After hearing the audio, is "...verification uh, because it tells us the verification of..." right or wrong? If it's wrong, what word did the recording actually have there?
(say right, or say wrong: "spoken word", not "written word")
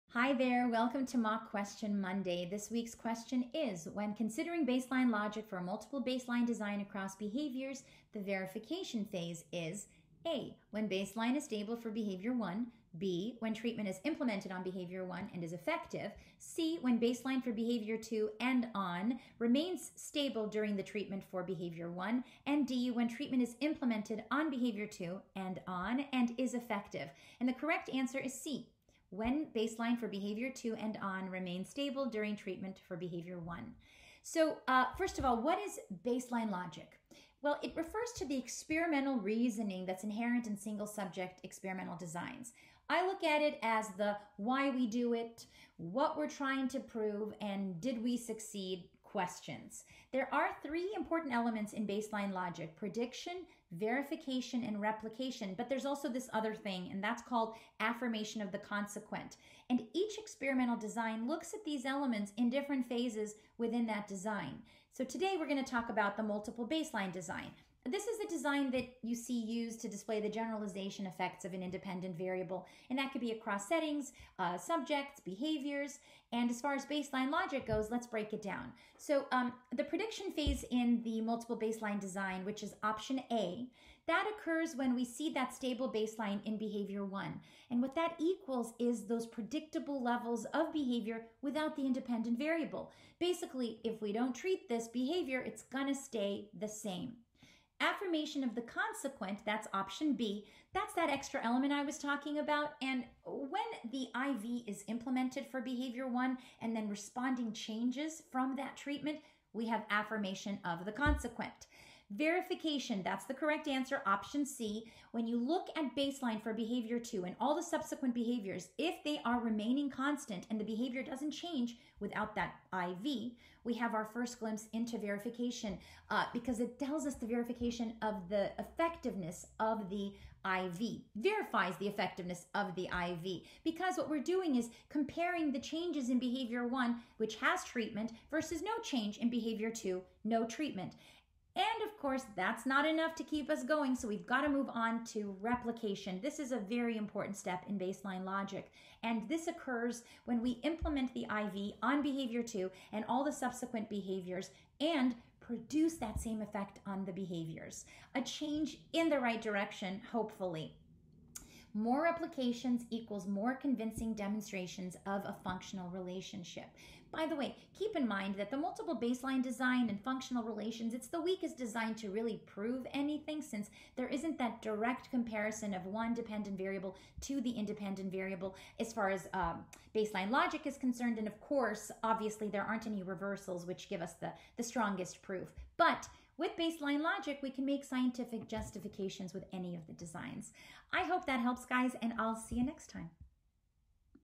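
right.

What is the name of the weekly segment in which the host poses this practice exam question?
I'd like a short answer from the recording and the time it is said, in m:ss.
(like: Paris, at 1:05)
Mock Question Monday, at 0:01.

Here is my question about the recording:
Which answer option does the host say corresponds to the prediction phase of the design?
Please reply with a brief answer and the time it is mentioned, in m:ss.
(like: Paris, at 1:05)
option A, at 1:22.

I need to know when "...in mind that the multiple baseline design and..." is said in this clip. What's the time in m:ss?
2:47.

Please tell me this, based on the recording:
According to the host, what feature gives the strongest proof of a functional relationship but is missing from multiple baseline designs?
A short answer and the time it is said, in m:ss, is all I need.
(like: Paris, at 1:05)
reversals, at 3:03.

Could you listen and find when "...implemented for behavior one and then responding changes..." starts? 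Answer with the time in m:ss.
1:44.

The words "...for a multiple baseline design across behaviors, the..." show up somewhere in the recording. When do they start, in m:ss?
0:05.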